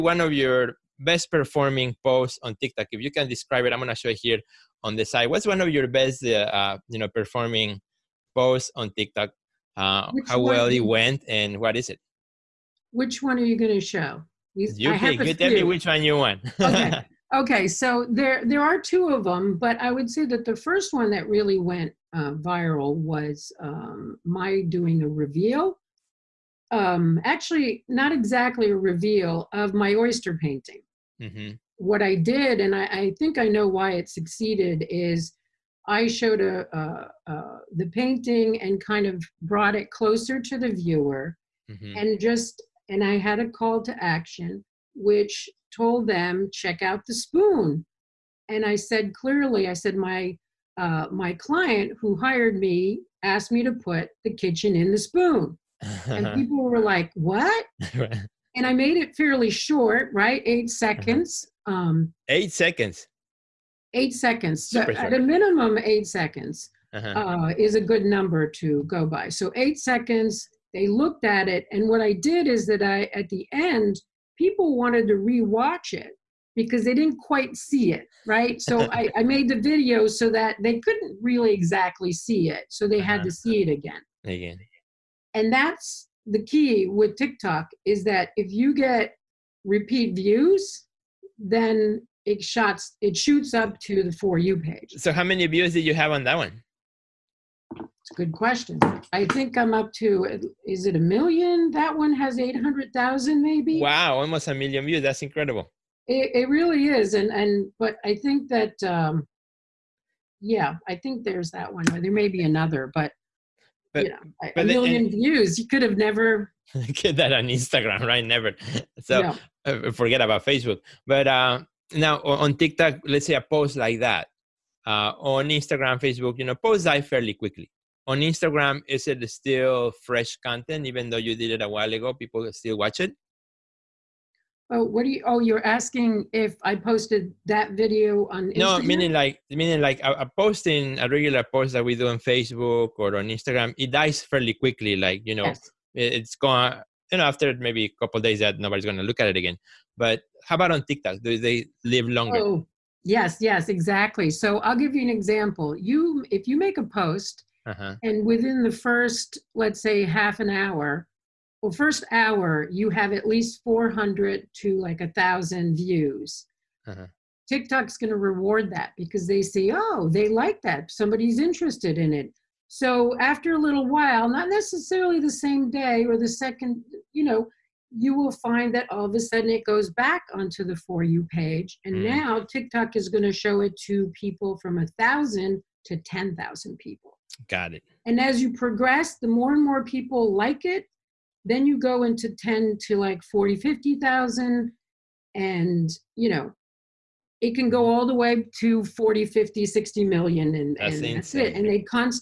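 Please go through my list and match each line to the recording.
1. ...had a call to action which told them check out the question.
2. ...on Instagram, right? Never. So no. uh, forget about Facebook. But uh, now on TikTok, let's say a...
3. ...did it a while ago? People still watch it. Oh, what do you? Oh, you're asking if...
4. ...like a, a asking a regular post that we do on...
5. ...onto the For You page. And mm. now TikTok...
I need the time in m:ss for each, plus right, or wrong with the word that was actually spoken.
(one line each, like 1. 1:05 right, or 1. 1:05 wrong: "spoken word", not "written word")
1. 0:43 wrong: "spoon", not "question"
2. 1:57 right
3. 2:11 right
4. 2:19 wrong: "posting", not "asking"
5. 3:00 right.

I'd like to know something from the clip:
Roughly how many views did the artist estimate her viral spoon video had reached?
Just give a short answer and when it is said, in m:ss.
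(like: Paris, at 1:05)
800,000, at 1:42.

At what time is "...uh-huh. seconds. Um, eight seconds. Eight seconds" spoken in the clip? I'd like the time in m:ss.
1:00.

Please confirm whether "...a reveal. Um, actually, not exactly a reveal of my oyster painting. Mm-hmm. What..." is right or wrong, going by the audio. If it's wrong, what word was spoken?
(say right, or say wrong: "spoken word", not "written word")
right.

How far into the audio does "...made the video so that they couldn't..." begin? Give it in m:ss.
1:19.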